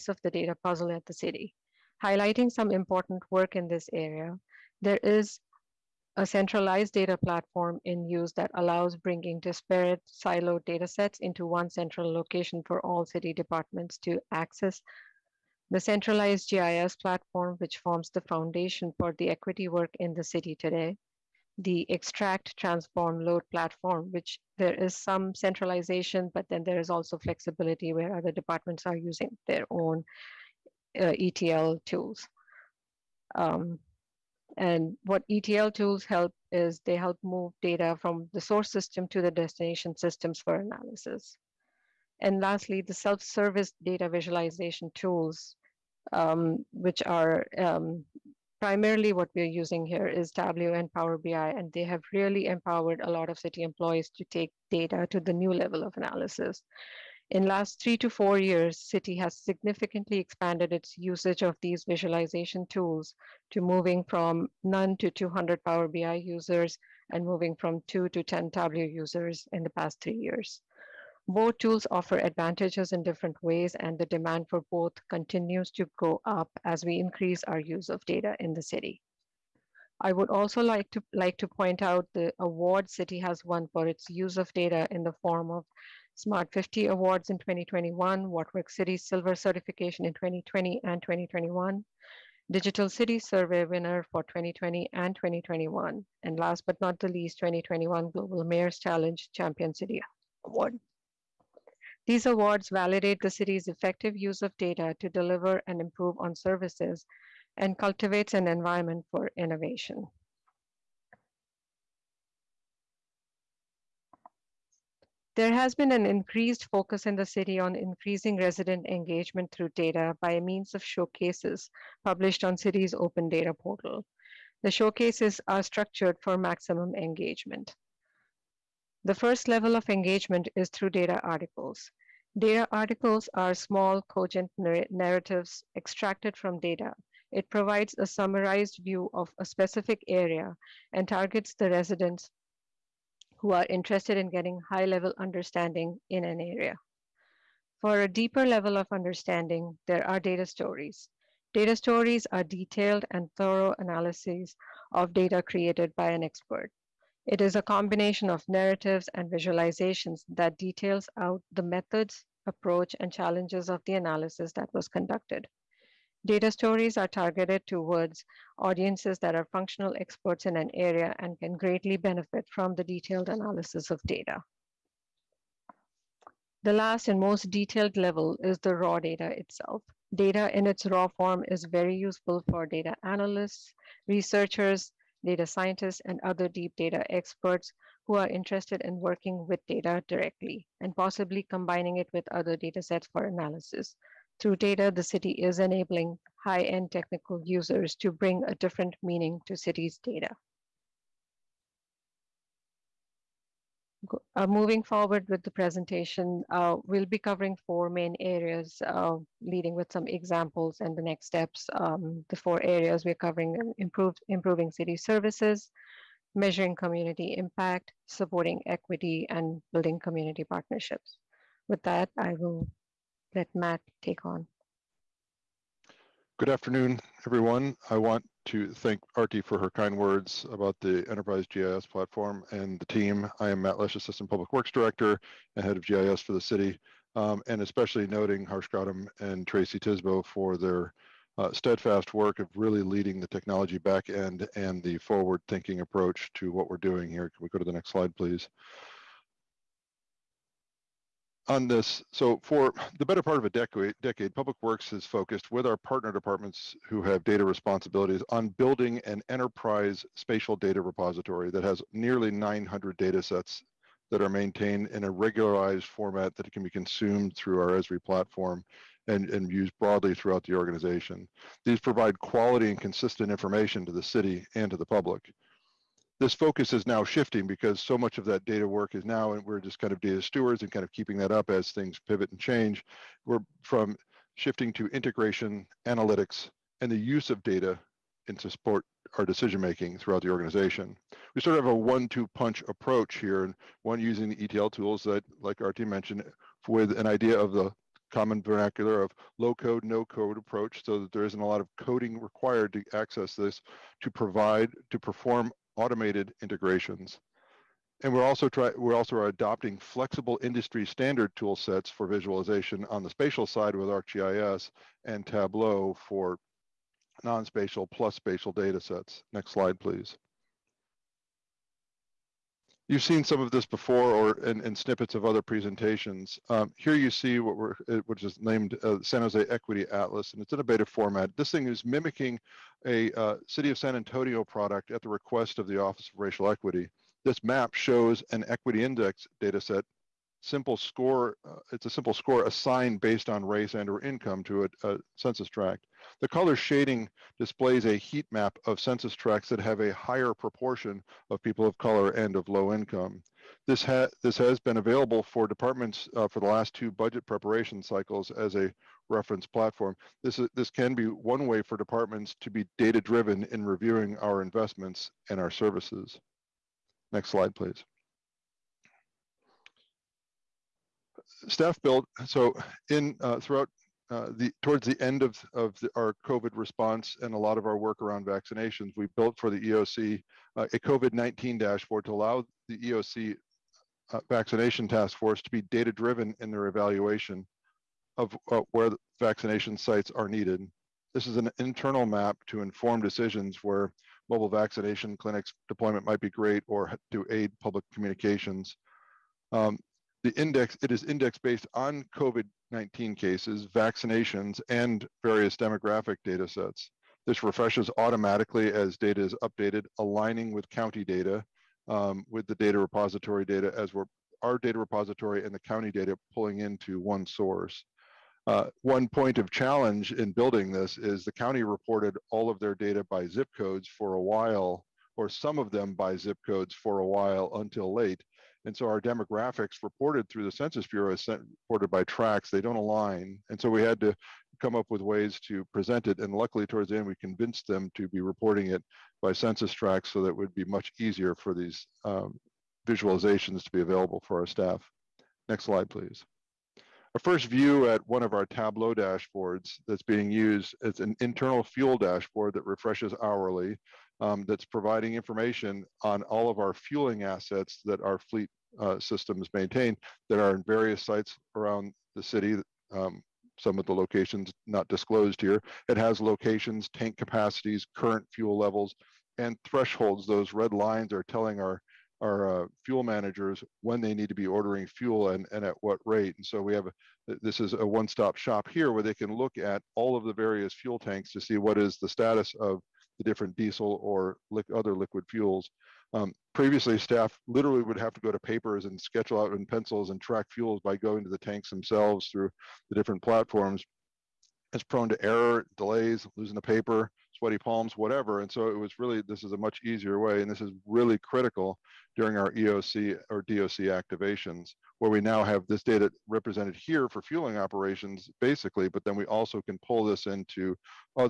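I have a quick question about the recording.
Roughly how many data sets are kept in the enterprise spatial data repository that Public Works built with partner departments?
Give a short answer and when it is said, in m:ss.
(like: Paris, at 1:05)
900, at 4:22.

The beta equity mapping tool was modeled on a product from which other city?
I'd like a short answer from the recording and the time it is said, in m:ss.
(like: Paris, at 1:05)
San Antonio, at 5:33.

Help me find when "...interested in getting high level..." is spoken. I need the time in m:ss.
2:23.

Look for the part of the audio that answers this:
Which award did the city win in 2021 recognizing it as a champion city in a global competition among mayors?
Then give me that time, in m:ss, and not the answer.
1:38.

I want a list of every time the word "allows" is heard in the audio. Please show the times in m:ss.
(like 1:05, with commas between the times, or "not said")
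0:08, 6:22.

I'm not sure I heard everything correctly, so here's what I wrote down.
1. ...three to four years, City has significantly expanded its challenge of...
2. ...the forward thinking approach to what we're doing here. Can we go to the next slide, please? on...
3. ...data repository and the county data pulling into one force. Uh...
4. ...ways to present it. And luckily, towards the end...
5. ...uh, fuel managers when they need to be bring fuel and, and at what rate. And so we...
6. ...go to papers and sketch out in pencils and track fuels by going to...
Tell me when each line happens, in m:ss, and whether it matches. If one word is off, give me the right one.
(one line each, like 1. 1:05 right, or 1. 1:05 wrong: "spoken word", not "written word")
1. 0:57 wrong: "usage", not "challenge"
2. 4:04 right
3. 6:54 wrong: "source", not "force"
4. 7:15 right
5. 7:52 wrong: "ordering", not "bring"
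6. 8:08 right.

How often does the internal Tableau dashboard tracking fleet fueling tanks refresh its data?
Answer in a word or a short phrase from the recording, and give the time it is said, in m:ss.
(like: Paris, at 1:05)
Hourly, at 7:33.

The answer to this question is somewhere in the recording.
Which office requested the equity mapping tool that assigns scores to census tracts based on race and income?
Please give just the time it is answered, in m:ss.
5:35.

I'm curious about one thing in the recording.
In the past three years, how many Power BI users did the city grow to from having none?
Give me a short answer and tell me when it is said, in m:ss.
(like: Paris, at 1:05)
200, at 1:05.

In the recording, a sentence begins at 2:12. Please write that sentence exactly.
Data articles are small, cogent narr narratives extracted from data.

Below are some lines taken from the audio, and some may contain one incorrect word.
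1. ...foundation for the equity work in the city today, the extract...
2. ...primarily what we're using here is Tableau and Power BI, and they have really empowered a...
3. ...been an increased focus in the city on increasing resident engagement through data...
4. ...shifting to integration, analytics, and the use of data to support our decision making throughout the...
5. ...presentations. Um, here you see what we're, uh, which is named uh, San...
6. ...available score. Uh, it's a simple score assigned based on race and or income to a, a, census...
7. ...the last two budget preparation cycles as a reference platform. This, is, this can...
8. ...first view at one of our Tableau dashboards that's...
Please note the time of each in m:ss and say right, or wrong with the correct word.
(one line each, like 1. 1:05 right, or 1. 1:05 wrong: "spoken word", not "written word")
1. 0:18 right
2. 0:48 right
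3. 1:55 right
4. 4:44 right
5. 5:25 right
6. 5:40 wrong: "simple", not "available"
7. 5:56 right
8. 7:27 right.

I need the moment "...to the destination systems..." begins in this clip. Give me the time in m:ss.
0:39.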